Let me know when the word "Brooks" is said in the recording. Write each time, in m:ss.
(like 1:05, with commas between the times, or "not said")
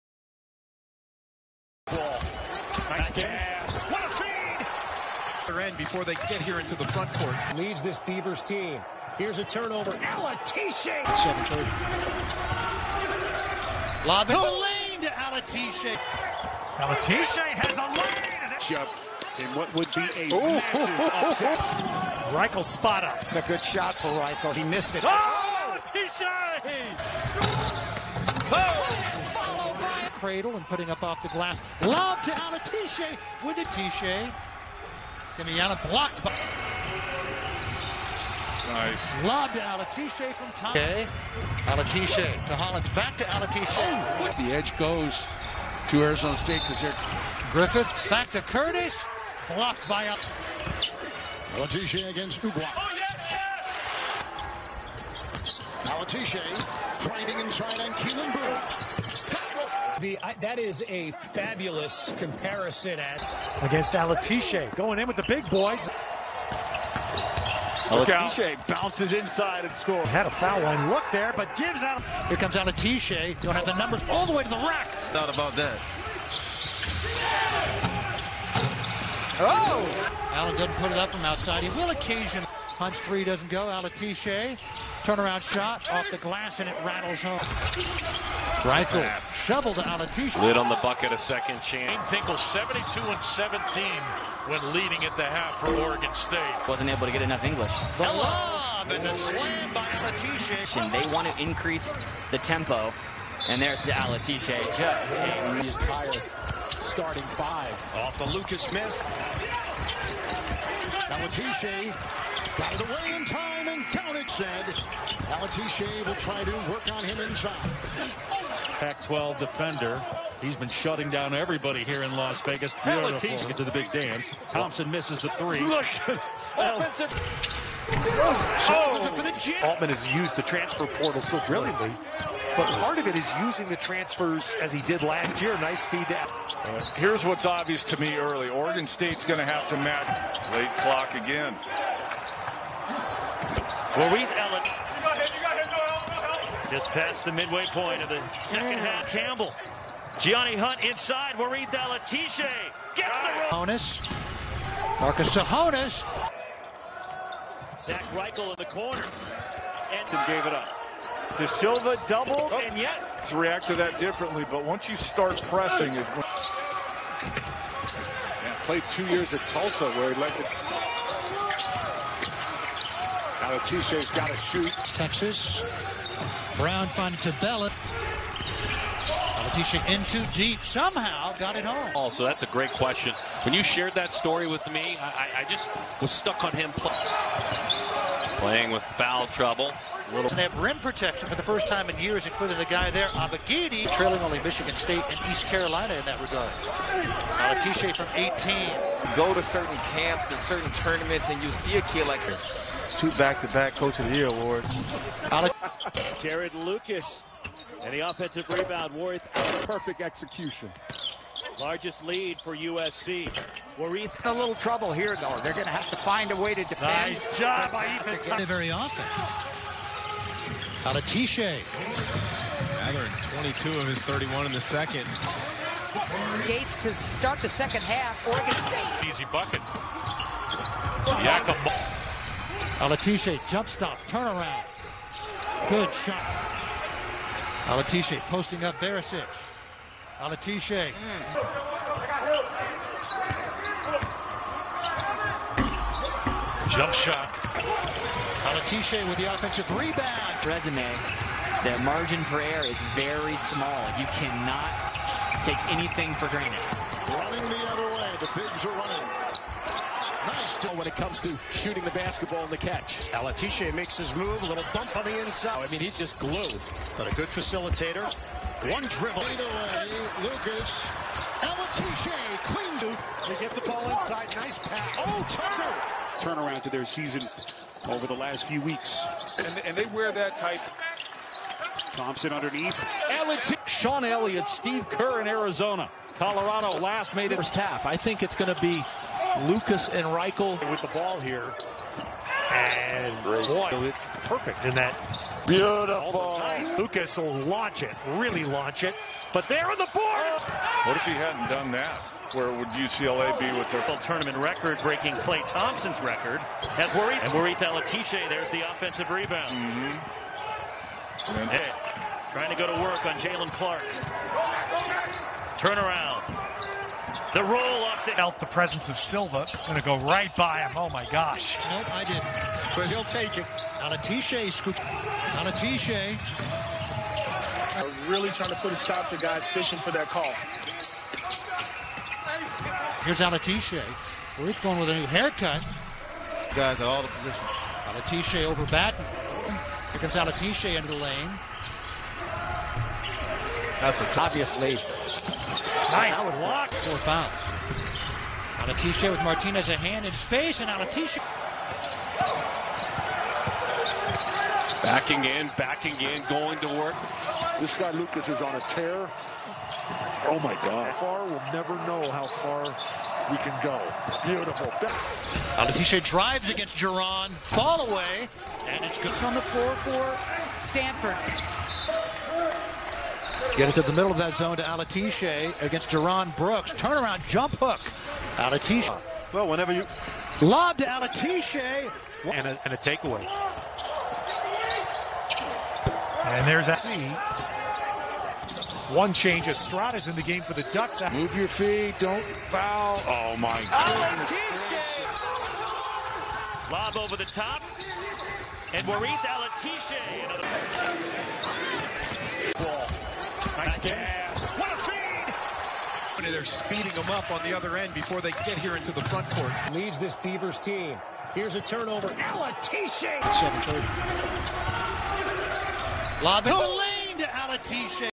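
6:16.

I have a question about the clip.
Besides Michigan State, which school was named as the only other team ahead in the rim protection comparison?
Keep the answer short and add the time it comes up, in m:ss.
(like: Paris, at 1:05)
East Carolina, at 3:15.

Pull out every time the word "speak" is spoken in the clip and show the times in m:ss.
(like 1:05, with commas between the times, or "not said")
not said.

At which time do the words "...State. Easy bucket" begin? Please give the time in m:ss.
3:48.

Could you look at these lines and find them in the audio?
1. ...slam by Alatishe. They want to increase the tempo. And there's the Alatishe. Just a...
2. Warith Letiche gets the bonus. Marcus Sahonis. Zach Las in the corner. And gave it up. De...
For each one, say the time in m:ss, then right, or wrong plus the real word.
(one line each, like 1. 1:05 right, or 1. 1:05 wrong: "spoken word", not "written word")
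1. 1:39 right
2. 2:31 wrong: "Reichle", not "Las".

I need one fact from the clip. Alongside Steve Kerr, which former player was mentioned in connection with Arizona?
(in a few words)
Sean Elliott.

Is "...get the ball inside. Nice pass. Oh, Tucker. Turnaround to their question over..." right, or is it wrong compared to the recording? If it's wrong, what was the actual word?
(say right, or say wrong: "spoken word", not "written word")
wrong: "season", not "question".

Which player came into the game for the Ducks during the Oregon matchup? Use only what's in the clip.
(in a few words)
Estrada.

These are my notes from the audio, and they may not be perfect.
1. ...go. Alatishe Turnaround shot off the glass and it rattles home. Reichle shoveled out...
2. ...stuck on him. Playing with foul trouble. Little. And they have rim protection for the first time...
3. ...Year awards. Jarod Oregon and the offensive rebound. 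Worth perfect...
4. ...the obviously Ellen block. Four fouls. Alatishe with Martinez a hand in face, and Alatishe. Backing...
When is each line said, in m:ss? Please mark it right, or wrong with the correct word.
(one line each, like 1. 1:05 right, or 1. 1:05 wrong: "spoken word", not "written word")
1. 1:23 right
2. 3:06 right
3. 3:24 wrong: "Lucas", not "Oregon"
4. 5:44 wrong: "Nice", not "Ellen".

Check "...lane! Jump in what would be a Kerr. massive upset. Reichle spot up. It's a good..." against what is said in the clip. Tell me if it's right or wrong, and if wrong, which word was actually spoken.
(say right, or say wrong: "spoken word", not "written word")
wrong: "Ooh", not "Kerr".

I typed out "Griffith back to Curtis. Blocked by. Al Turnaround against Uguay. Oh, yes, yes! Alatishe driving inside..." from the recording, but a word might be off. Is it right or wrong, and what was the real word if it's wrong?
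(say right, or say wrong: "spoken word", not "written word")
wrong: "Alatishe", not "Turnaround".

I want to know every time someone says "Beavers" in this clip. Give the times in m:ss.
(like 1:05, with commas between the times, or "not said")
0:07, 6:50.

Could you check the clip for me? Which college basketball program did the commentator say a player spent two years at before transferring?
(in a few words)
Tulsa.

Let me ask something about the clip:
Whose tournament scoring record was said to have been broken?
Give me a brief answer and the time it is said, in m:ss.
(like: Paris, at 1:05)
Klay Thompson, at 5:05.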